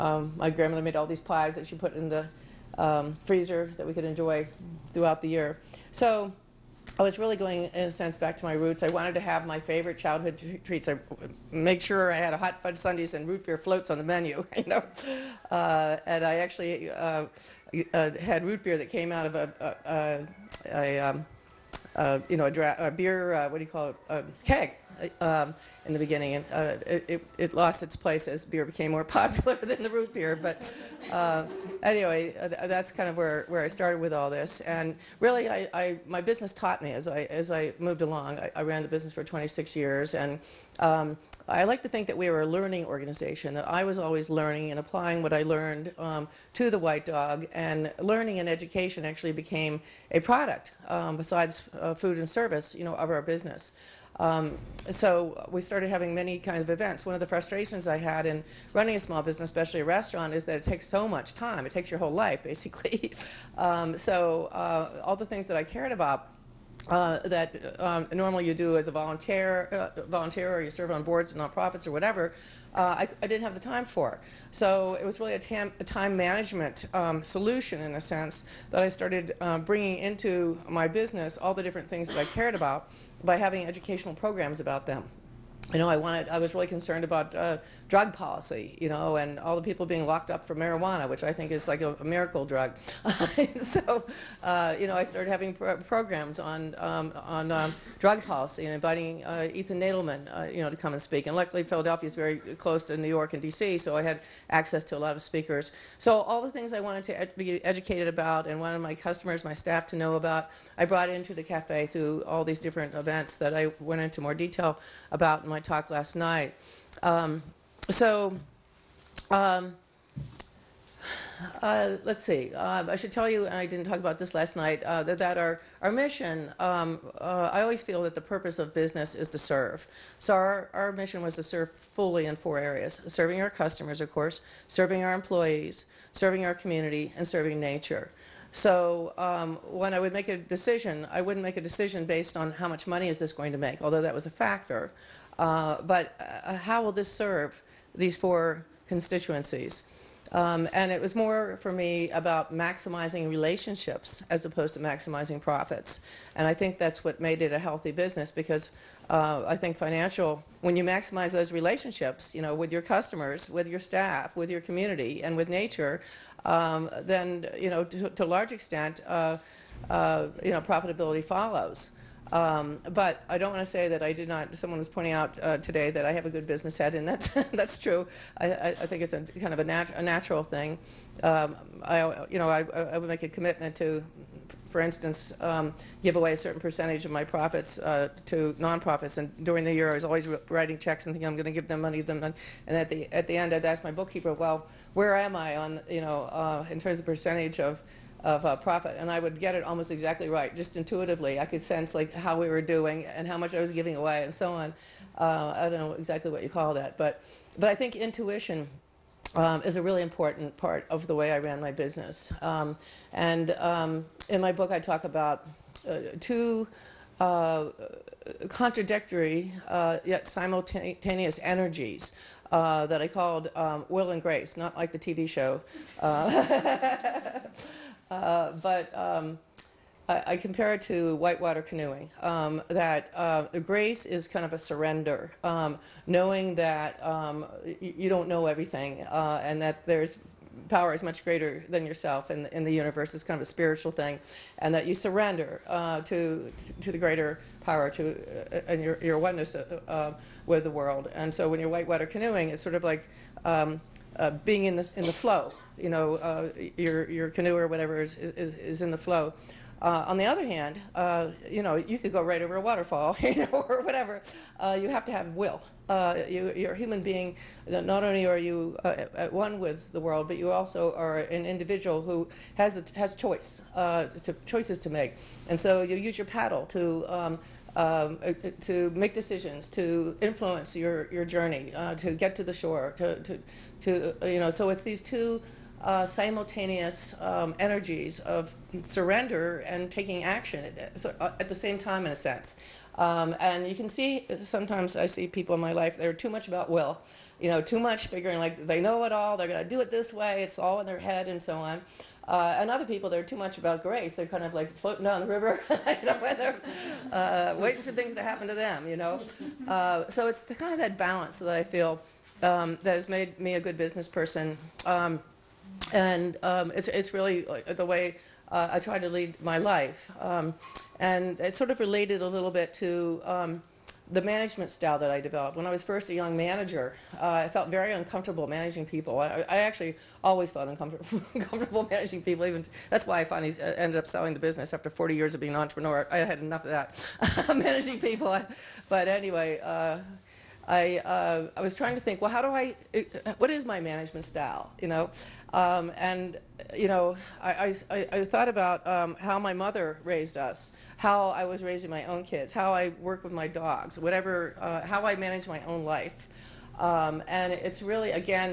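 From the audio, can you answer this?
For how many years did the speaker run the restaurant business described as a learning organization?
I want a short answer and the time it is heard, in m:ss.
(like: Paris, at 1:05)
26, at 0:39.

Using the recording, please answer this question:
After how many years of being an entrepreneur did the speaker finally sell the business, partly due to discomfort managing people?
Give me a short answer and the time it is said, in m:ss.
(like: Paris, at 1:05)
40, at 5:34.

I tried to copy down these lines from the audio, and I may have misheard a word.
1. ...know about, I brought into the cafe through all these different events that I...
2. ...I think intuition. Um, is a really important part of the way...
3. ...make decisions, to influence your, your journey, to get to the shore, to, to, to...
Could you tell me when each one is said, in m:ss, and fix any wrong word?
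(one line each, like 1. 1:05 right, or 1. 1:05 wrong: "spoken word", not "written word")
1. 1:49 right
2. 3:27 right
3. 4:38 right.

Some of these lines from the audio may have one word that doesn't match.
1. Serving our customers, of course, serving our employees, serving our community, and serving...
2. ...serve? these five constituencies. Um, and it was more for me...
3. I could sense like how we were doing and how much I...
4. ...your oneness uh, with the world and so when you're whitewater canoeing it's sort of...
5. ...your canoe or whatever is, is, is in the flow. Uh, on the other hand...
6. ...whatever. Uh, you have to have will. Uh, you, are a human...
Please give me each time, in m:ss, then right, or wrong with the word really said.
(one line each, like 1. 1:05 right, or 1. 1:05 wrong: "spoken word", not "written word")
1. 2:13 right
2. 2:27 wrong: "four", not "five"
3. 3:21 right
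4. 4:09 right
5. 4:17 right
6. 4:23 right.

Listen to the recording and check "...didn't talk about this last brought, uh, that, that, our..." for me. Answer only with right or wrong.
wrong.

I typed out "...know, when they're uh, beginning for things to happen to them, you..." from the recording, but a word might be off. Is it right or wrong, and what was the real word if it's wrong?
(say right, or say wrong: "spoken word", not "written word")
wrong: "waiting", not "beginning".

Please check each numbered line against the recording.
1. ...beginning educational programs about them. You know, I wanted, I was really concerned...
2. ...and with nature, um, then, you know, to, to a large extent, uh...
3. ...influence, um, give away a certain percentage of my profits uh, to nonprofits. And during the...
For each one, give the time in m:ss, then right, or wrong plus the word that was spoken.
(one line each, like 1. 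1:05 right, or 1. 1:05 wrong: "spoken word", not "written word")
1. 1:23 wrong: "having", not "beginning"
2. 2:45 right
3. 3:04 wrong: "instance", not "influence".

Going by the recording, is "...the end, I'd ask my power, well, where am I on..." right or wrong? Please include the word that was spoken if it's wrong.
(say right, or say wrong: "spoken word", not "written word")
wrong: "bookkeeper", not "power".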